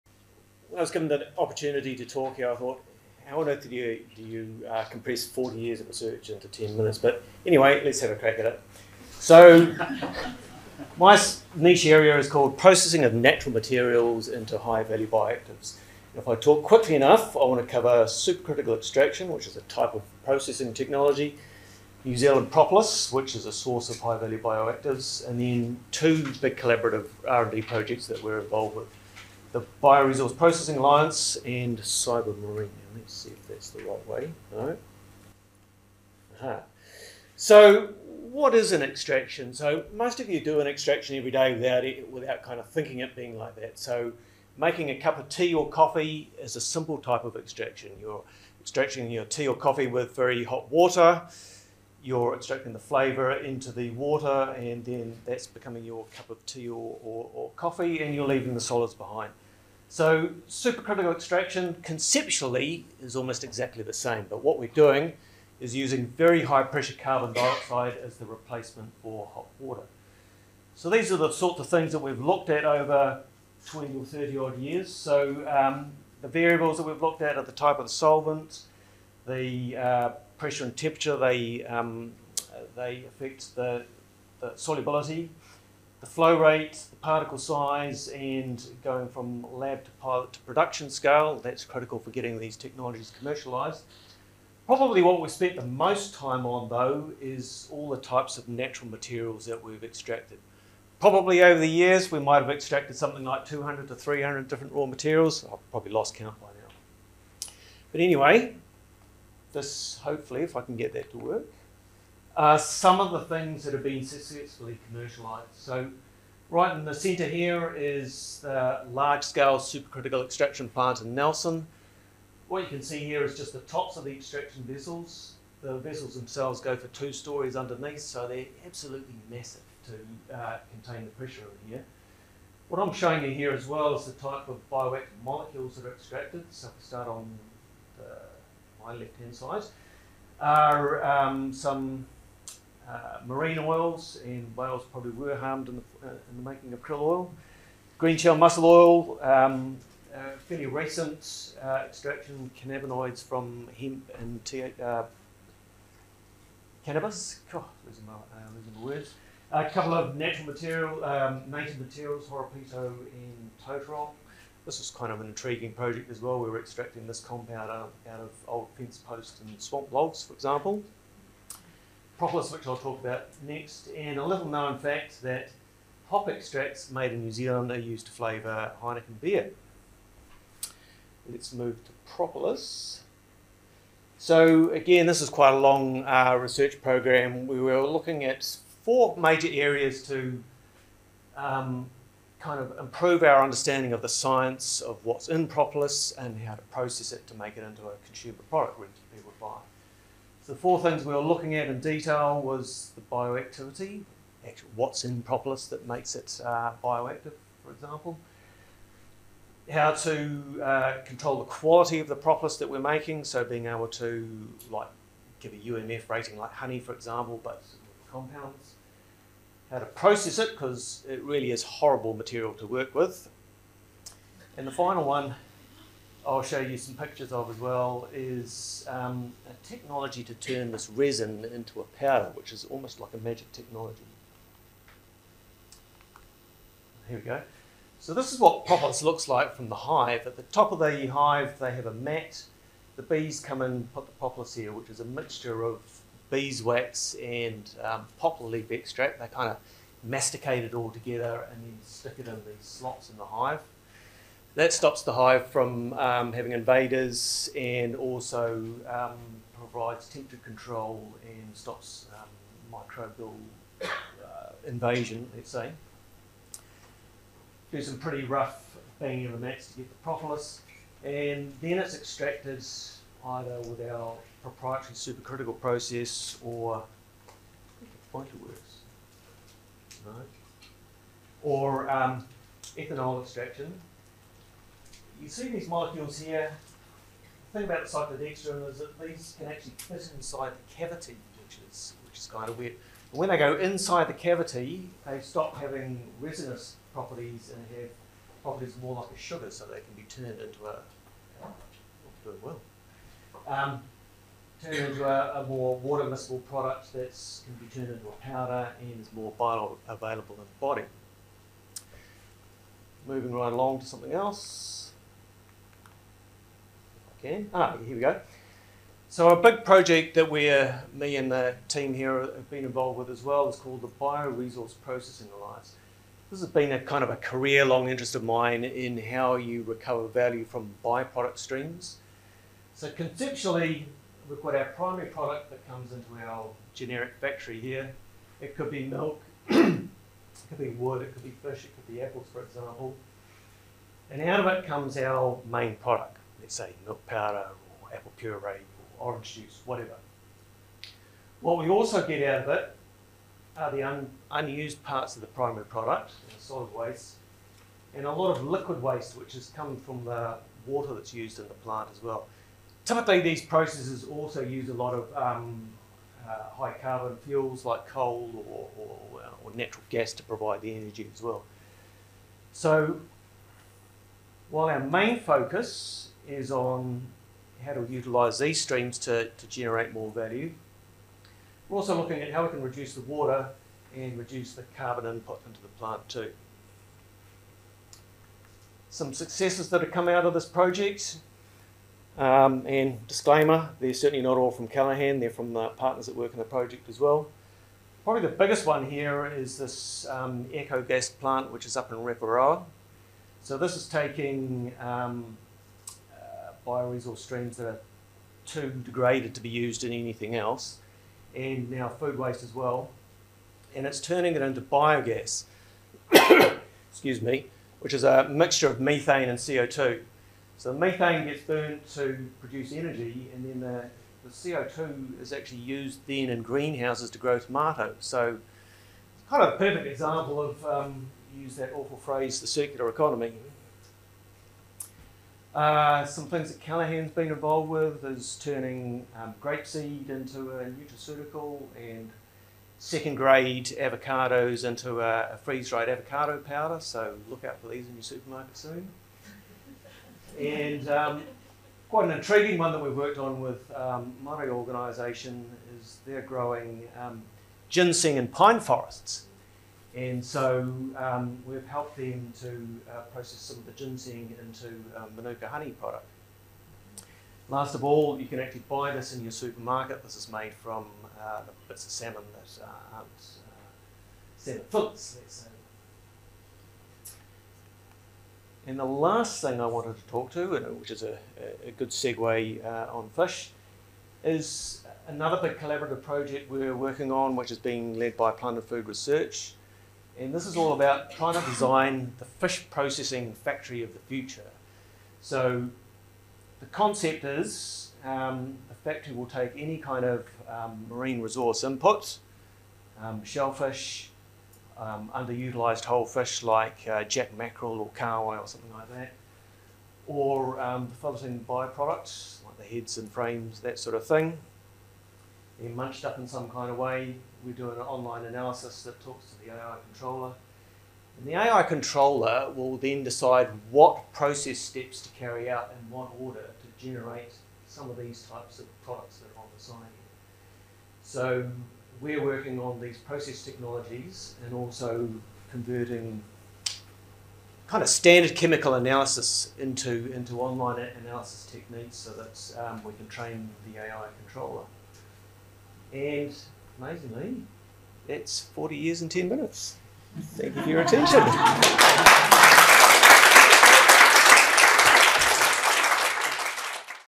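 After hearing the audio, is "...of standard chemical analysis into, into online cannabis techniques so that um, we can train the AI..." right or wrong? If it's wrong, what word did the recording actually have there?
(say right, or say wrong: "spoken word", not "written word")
wrong: "analysis", not "cannabis".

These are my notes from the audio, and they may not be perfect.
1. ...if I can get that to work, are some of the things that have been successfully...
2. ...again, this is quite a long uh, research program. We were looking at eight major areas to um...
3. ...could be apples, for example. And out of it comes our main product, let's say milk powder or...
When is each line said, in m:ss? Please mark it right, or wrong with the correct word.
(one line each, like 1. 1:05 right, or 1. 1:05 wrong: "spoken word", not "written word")
1. 1:50 right
2. 3:04 wrong: "four", not "eight"
3. 5:41 right.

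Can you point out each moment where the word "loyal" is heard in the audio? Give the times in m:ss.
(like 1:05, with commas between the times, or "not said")
not said.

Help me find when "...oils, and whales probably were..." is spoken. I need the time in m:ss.
2:23.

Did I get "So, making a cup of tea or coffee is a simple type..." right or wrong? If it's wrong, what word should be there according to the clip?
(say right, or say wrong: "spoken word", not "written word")
right.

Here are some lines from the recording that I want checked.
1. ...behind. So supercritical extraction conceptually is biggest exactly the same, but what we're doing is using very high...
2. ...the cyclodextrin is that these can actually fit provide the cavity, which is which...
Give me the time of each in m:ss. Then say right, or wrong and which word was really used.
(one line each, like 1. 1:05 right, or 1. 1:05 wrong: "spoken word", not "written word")
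1. 0:58 wrong: "almost", not "biggest"
2. 4:47 wrong: "inside", not "provide".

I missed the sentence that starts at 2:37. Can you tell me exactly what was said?
God, losing my, losing uh, my words.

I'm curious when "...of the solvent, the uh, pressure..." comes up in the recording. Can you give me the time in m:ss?
1:17.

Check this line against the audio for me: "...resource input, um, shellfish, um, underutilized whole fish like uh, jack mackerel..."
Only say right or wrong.
right.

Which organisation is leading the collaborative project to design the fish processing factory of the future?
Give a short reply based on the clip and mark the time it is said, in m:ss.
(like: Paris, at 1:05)
Plant and Food Research, at 8:08.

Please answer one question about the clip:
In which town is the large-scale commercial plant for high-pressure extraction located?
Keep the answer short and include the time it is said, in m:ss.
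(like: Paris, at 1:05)
Nelson, at 2:01.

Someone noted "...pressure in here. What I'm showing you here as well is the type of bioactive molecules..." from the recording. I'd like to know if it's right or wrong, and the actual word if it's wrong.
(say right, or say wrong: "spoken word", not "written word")
right.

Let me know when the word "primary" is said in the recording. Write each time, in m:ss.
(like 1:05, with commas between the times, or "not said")
5:34, 5:55.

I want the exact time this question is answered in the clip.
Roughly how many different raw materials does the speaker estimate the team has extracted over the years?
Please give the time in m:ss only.
1:43.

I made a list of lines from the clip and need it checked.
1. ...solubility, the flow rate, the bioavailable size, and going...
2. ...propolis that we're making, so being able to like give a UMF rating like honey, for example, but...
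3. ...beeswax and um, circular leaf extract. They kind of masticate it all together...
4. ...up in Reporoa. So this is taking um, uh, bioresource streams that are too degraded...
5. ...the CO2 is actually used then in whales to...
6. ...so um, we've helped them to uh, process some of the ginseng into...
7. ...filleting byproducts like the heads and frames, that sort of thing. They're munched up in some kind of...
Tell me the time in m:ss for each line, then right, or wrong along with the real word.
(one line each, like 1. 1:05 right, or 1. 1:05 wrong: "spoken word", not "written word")
1. 1:24 wrong: "particle", not "bioavailable"
2. 3:32 right
3. 4:06 wrong: "poplar", not "circular"
4. 6:41 right
5. 7:04 wrong: "greenhouses", not "whales"
6. 7:40 right
7. 8:31 right.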